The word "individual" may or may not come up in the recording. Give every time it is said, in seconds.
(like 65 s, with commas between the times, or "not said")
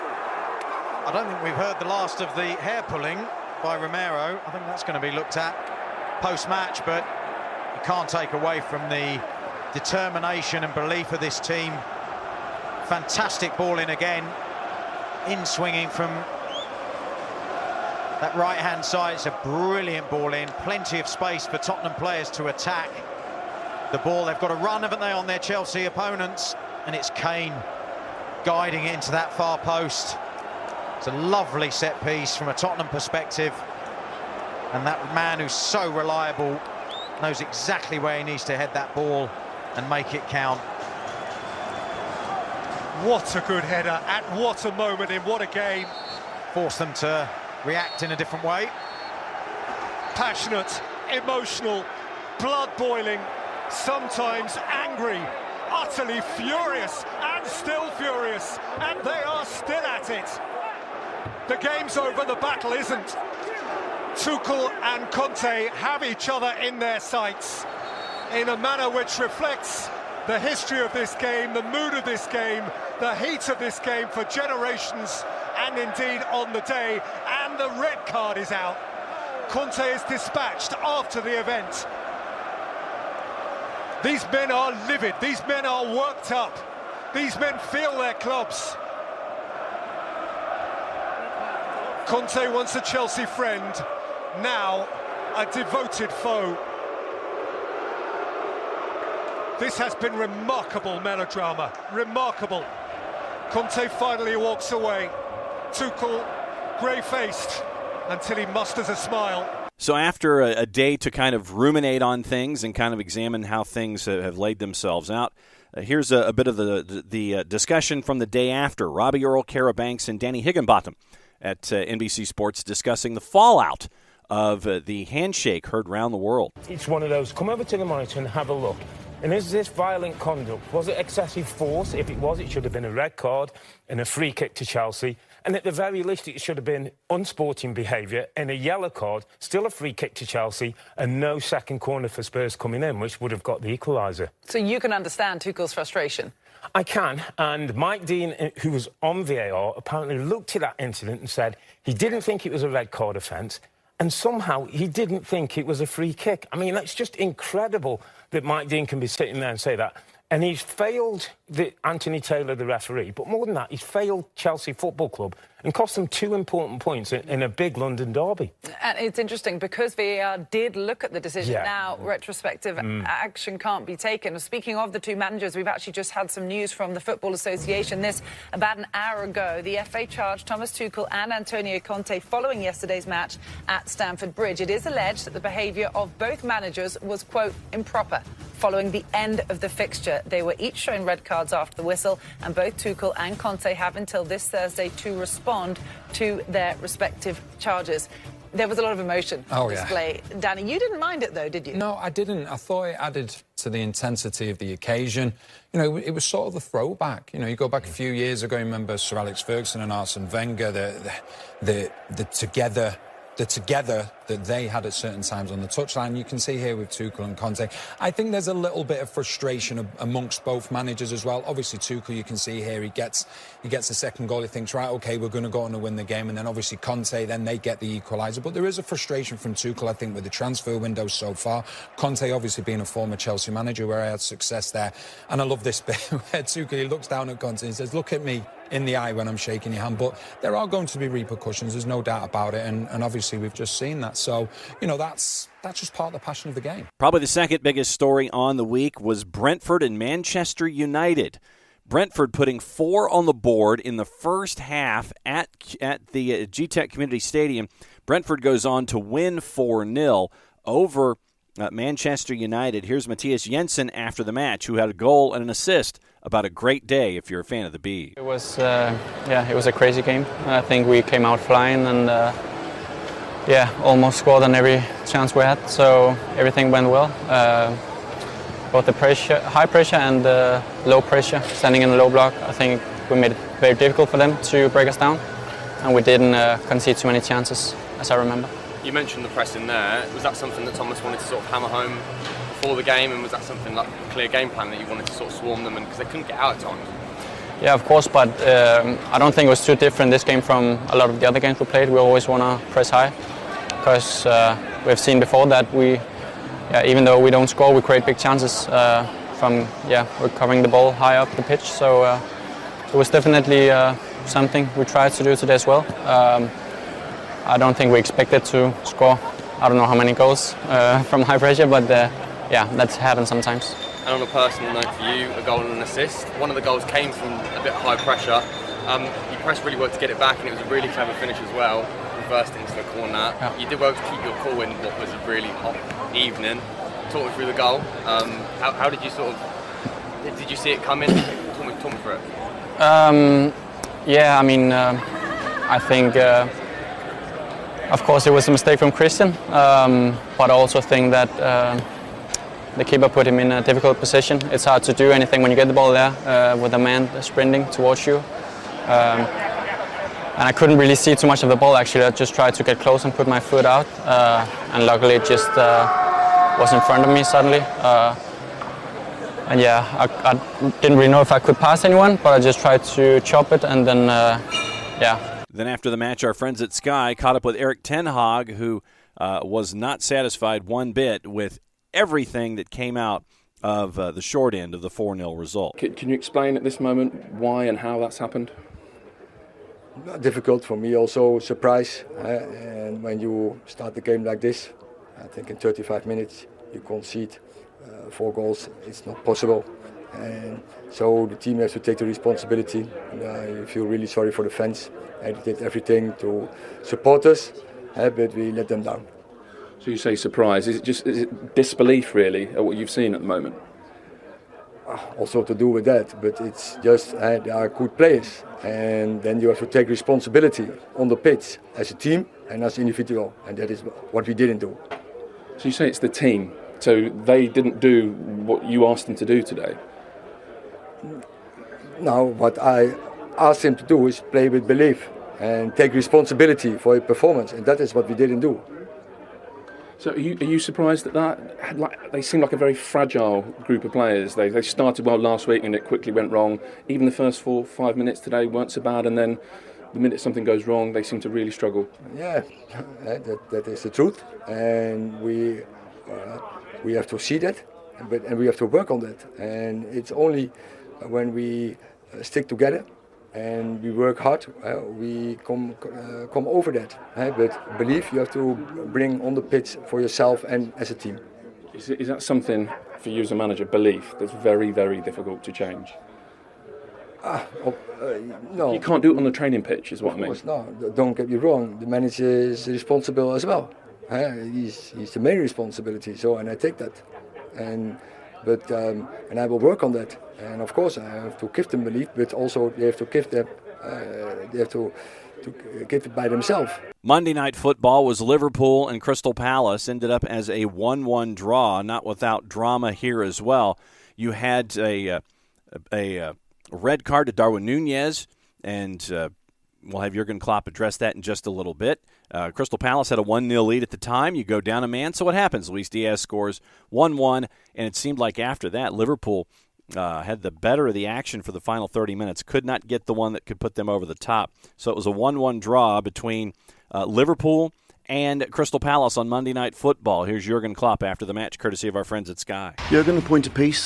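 422 s.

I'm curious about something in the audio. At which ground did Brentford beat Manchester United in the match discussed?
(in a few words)
Gtech Community Stadium.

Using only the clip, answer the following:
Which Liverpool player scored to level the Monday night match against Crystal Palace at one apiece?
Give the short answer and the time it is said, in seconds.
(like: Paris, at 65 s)
Luis Diaz, at 515 s.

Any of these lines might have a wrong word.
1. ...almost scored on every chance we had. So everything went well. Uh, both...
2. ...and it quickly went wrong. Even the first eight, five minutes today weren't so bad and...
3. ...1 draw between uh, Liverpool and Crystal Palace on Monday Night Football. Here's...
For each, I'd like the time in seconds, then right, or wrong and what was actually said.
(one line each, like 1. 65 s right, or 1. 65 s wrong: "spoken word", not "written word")
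1. 273 s right
2. 445 s wrong: "four", not "eight"
3. 525 s right.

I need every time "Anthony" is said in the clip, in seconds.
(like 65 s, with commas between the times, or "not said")
161 s.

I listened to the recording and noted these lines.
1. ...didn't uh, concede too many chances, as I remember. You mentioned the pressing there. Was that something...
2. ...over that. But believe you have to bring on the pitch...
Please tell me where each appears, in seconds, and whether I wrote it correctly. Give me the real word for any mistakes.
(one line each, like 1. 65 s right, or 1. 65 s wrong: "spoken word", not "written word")
1. 286 s right
2. 466 s right.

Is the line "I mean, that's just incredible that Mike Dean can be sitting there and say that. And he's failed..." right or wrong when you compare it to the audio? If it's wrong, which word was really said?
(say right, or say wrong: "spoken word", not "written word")
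right.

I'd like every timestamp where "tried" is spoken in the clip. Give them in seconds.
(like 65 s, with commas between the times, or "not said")
314 s, 362 s, 372 s.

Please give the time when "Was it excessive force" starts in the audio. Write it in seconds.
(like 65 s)
130 s.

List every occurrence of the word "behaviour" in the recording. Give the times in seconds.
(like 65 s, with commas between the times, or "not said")
137 s, 185 s.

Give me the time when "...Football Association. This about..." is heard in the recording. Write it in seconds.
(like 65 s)
177 s.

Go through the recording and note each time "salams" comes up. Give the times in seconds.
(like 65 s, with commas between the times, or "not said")
not said.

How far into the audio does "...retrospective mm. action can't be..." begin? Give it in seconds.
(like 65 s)
172 s.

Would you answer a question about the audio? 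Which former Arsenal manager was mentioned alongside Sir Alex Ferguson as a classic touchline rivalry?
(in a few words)
Arsene Wenger.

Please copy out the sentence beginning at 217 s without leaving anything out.
I think there's a little bit of frustration amongst both managers as well.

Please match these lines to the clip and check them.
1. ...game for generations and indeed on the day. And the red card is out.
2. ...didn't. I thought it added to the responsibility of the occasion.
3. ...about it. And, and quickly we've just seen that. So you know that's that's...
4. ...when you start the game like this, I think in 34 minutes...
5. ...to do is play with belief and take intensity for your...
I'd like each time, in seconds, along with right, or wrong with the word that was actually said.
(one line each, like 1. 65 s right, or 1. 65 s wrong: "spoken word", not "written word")
1. 73 s right
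2. 202 s wrong: "intensity", not "responsibility"
3. 242 s wrong: "obviously", not "quickly"
4. 393 s wrong: "35", not "34"
5. 433 s wrong: "responsibility", not "intensity".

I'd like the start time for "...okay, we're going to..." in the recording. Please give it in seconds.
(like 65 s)
224 s.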